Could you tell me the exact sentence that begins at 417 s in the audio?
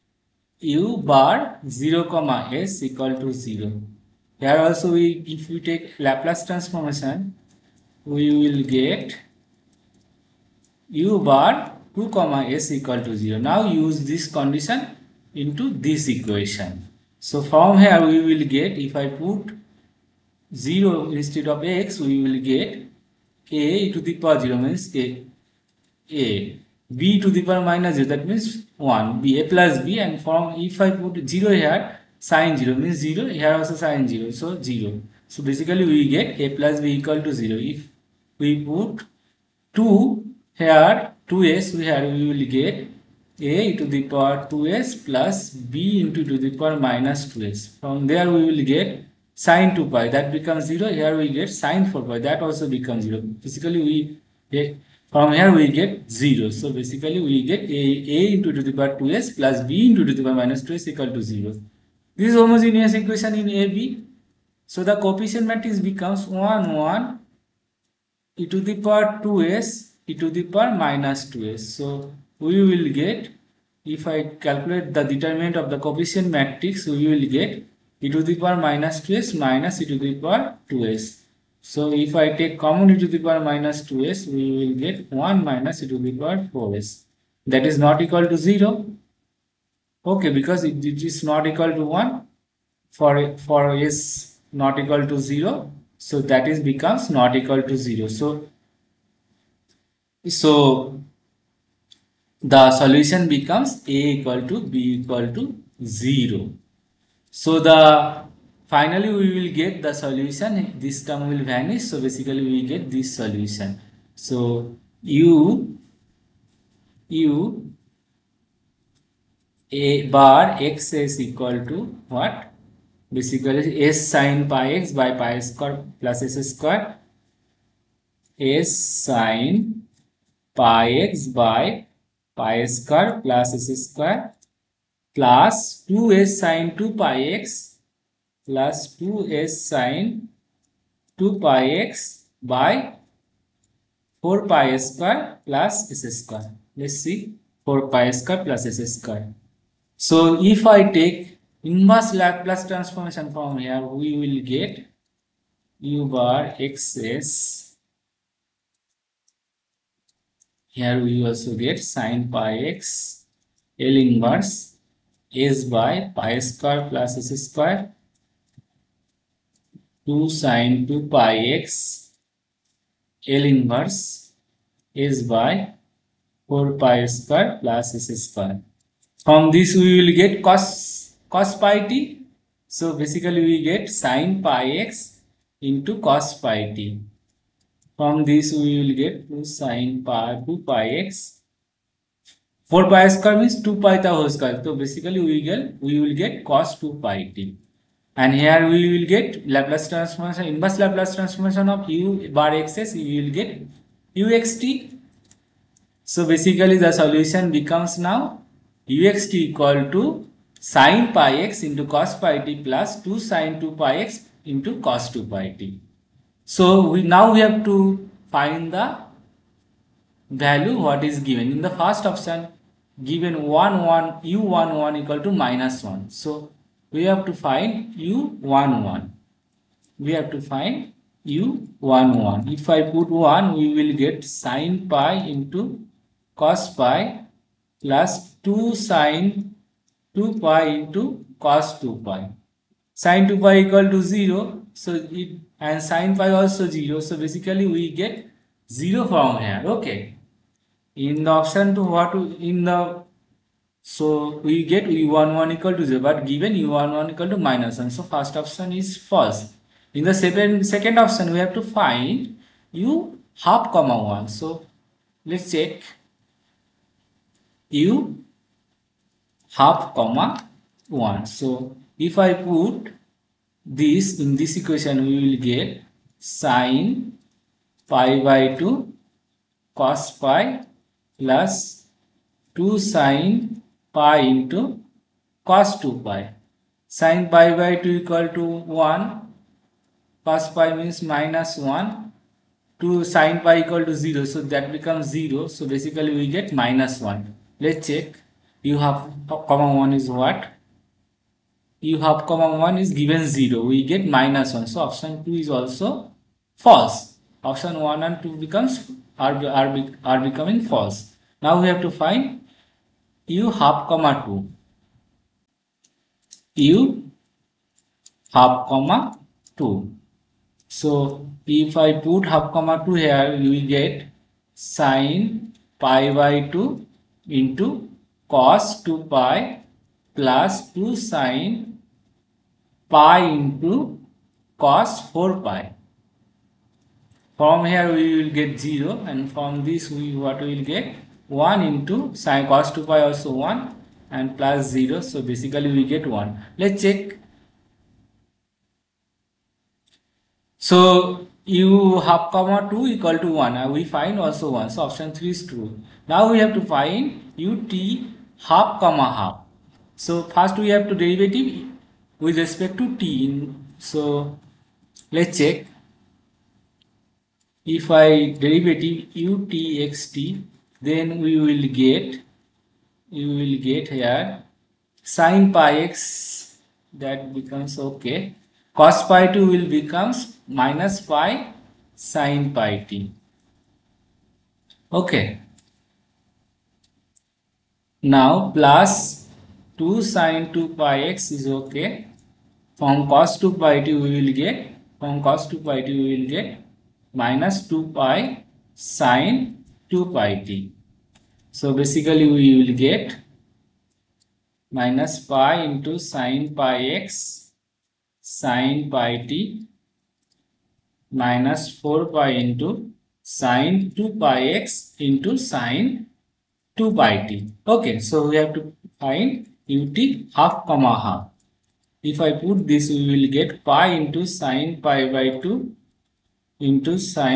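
Okay, so we have to find ut half comma half.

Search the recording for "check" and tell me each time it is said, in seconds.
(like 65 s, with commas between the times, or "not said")
265 s, 297 s, 346 s, 365 s.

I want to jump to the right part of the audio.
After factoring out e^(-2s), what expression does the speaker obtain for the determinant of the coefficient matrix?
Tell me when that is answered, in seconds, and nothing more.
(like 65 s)
85 s.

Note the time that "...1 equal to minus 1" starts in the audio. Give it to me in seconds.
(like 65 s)
224 s.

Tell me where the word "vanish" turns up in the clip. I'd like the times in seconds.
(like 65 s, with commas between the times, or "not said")
111 s.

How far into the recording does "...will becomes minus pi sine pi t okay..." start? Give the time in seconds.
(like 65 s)
379 s.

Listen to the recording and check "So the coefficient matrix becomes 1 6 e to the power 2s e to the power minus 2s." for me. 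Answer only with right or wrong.
wrong.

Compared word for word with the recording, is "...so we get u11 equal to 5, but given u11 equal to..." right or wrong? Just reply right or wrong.
wrong.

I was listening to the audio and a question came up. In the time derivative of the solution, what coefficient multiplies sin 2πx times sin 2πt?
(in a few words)
-4π.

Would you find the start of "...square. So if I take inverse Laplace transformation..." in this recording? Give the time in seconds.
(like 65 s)
148 s.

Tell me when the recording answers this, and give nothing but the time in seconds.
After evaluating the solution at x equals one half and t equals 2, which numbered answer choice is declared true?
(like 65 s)
354 s.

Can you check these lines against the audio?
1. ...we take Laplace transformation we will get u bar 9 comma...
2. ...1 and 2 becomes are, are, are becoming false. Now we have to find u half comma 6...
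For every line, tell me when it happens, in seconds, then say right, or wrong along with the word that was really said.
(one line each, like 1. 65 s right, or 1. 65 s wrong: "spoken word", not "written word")
1. 5 s wrong: "2", not "9"
2. 307 s wrong: "2", not "6".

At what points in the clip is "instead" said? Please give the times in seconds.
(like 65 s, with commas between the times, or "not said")
21 s.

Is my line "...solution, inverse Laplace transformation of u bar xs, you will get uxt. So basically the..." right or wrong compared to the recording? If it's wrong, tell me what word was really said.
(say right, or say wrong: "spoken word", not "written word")
wrong: "transformation", not "solution".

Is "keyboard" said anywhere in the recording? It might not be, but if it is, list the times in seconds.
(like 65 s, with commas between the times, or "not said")
not said.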